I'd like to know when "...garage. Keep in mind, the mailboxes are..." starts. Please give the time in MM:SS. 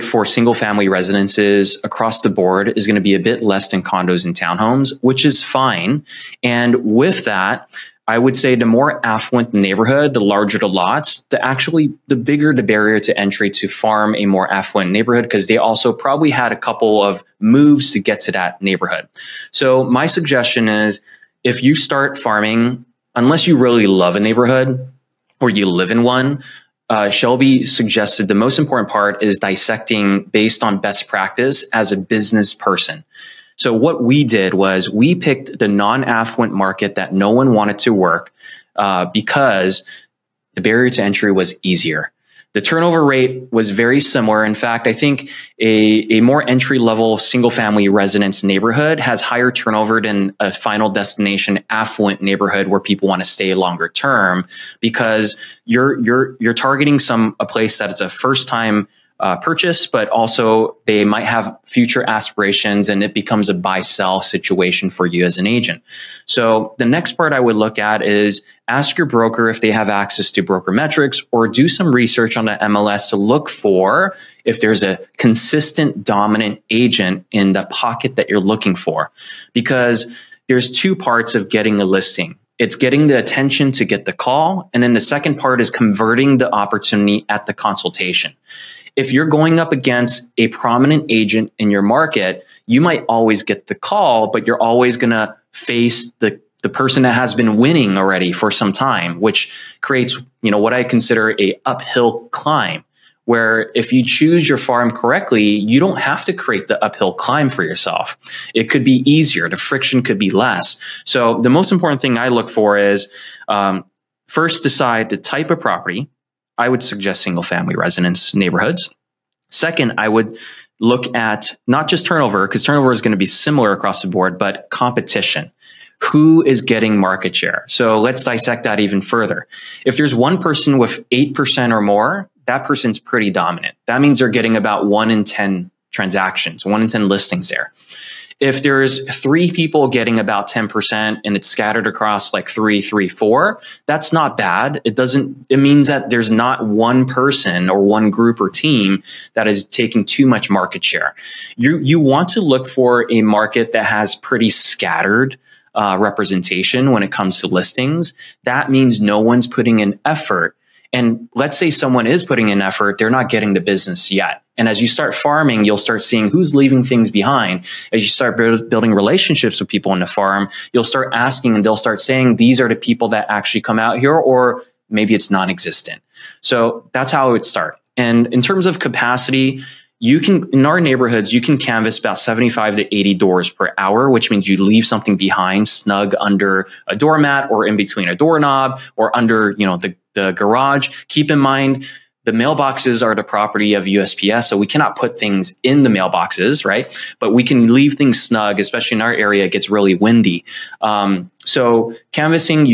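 03:10.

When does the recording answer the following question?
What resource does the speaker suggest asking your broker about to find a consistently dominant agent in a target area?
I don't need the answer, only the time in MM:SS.
01:10.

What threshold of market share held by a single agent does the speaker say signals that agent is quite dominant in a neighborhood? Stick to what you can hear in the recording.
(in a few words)
8%.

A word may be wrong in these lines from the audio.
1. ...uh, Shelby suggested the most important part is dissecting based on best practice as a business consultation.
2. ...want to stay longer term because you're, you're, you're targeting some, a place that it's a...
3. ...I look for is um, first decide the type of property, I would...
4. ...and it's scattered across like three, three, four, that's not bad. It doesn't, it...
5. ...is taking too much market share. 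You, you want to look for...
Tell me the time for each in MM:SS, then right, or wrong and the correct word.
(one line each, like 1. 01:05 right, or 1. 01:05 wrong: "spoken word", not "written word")
1. 00:26 wrong: "person", not "consultation"
2. 00:53 right
3. 01:52 right
4. 02:21 right
5. 02:29 right.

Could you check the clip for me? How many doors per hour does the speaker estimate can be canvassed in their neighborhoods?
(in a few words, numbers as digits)
75 to 80.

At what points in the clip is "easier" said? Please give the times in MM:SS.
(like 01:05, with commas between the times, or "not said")
00:41, 01:49.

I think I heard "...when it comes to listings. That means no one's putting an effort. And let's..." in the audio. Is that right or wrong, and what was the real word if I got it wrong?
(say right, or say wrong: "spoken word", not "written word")
right.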